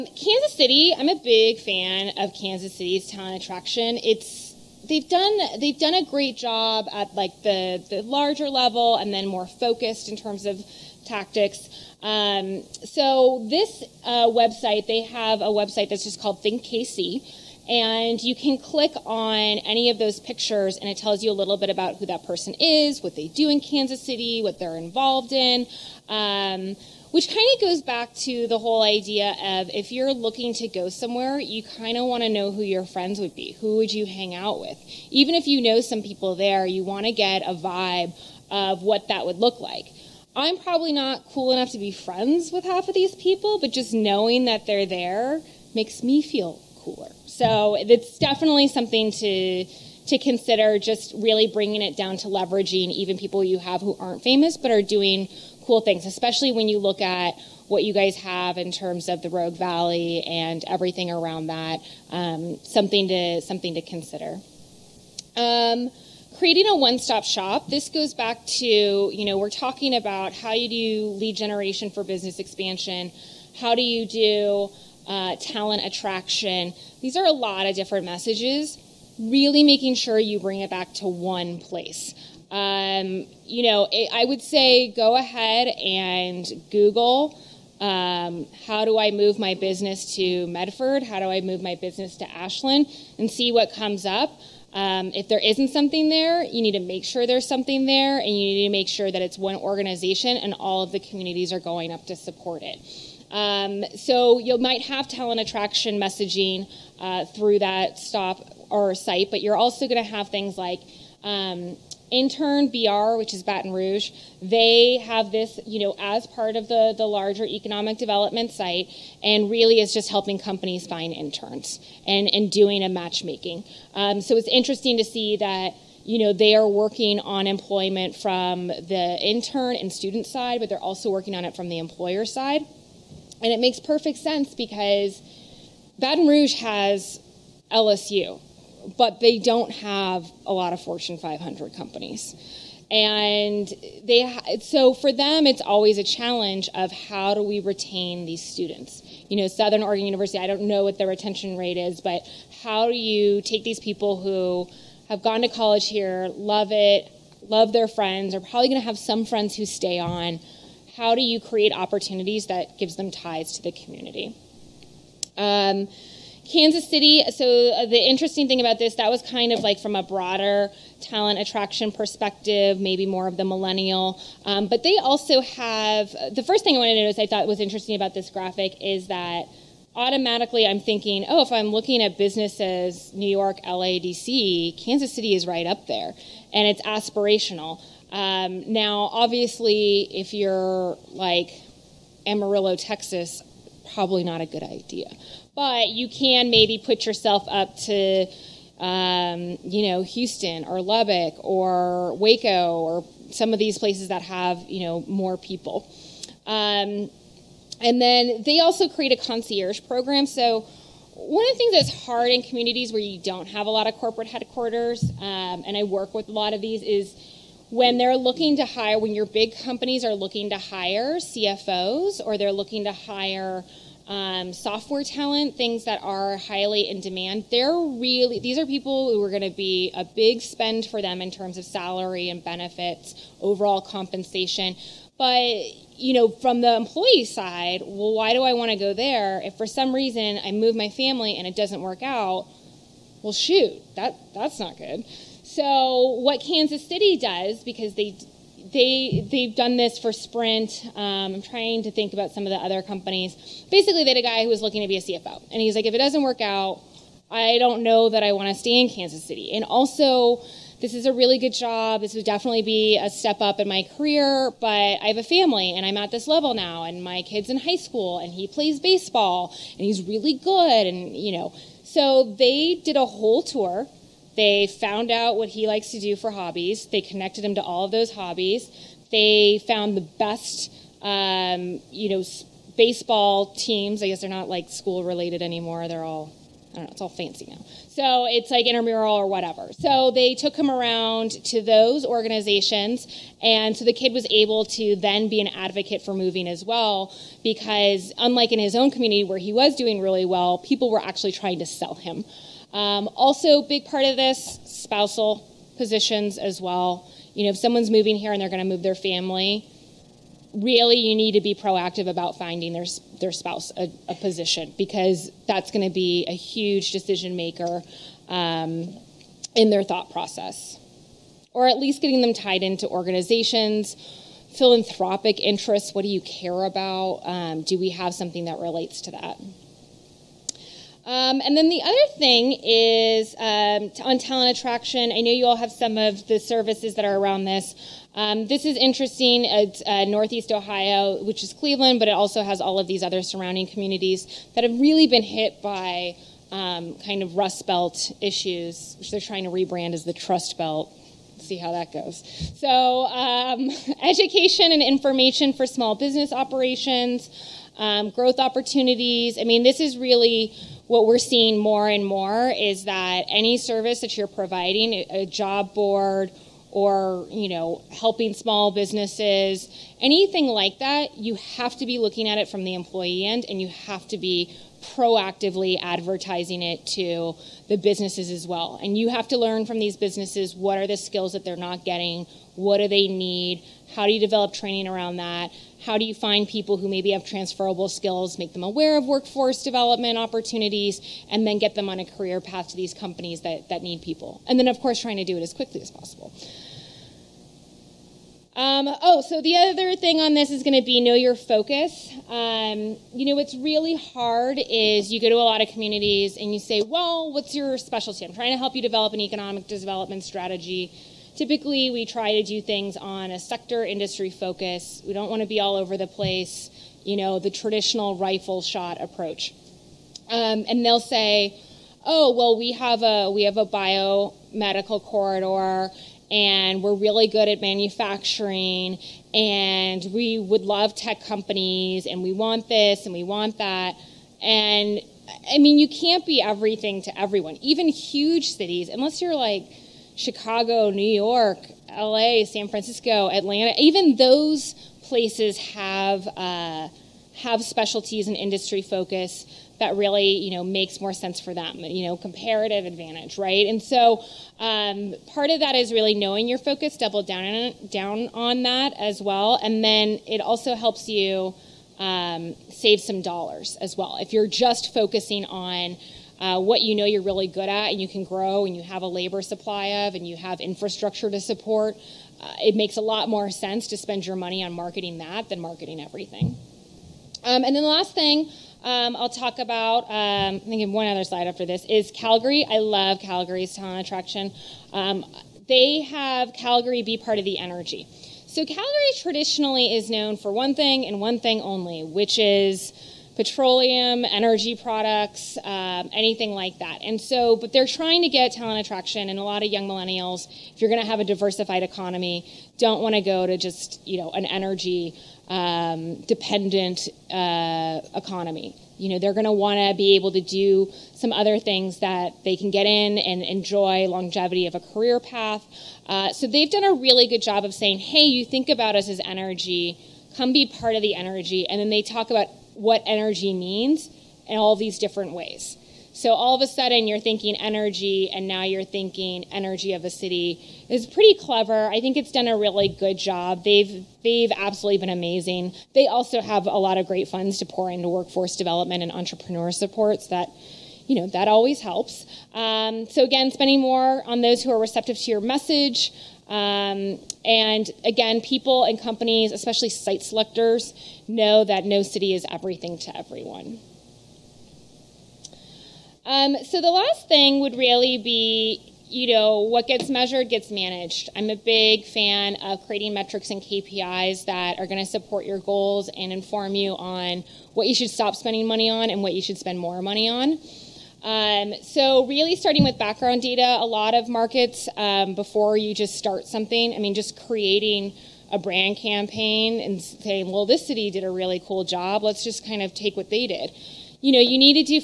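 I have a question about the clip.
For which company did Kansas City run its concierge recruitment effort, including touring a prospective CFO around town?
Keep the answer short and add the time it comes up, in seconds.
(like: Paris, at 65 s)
Sprint, at 250 s.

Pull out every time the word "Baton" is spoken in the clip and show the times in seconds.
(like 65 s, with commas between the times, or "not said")
113 s, 135 s.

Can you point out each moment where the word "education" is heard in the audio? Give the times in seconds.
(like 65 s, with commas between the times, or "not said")
354 s.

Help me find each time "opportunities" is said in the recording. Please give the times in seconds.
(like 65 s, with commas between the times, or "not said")
161 s, 358 s, 390 s.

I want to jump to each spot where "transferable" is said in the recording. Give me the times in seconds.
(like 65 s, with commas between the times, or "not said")
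387 s.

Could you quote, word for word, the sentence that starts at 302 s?
Um, also, big part of this, spousal positions as well.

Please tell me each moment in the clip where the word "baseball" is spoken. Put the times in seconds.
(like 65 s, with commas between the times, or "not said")
268 s, 282 s.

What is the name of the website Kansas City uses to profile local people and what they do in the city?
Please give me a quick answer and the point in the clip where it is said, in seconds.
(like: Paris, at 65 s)
Think KC, at 16 s.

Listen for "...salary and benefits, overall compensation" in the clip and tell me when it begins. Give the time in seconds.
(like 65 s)
231 s.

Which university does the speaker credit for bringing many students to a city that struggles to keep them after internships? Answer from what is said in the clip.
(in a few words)
LSU.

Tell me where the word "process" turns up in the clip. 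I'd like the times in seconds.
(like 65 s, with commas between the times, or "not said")
320 s.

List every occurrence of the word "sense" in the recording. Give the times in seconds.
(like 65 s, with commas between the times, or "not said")
134 s, 451 s, 473 s.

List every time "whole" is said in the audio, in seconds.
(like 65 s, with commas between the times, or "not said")
28 s, 273 s.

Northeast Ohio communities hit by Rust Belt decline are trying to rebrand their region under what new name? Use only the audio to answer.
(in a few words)
Trust Belt.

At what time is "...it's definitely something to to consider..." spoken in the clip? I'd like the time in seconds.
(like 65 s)
47 s.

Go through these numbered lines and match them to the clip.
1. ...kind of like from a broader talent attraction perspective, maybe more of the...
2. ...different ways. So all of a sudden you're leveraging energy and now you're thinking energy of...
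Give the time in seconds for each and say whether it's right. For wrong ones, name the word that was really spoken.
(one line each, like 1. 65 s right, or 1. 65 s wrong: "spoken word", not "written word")
1. 169 s right
2. 524 s wrong: "thinking", not "leveraging".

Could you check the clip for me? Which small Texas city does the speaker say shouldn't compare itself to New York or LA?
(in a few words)
Amarillo, Texas.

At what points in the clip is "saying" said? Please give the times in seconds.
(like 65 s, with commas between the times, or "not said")
517 s, 580 s.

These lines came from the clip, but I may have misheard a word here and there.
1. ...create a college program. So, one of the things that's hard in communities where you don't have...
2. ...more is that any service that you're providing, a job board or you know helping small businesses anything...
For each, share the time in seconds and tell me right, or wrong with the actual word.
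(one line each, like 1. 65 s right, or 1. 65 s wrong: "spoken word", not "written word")
1. 208 s wrong: "concierge", not "college"
2. 362 s right.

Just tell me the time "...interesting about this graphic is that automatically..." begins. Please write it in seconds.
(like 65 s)
177 s.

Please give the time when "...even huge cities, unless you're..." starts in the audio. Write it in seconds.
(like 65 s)
437 s.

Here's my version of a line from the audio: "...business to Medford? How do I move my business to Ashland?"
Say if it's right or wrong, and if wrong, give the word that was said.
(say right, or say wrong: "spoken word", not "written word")
right.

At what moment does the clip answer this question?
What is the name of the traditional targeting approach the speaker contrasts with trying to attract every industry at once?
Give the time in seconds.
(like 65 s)
418 s.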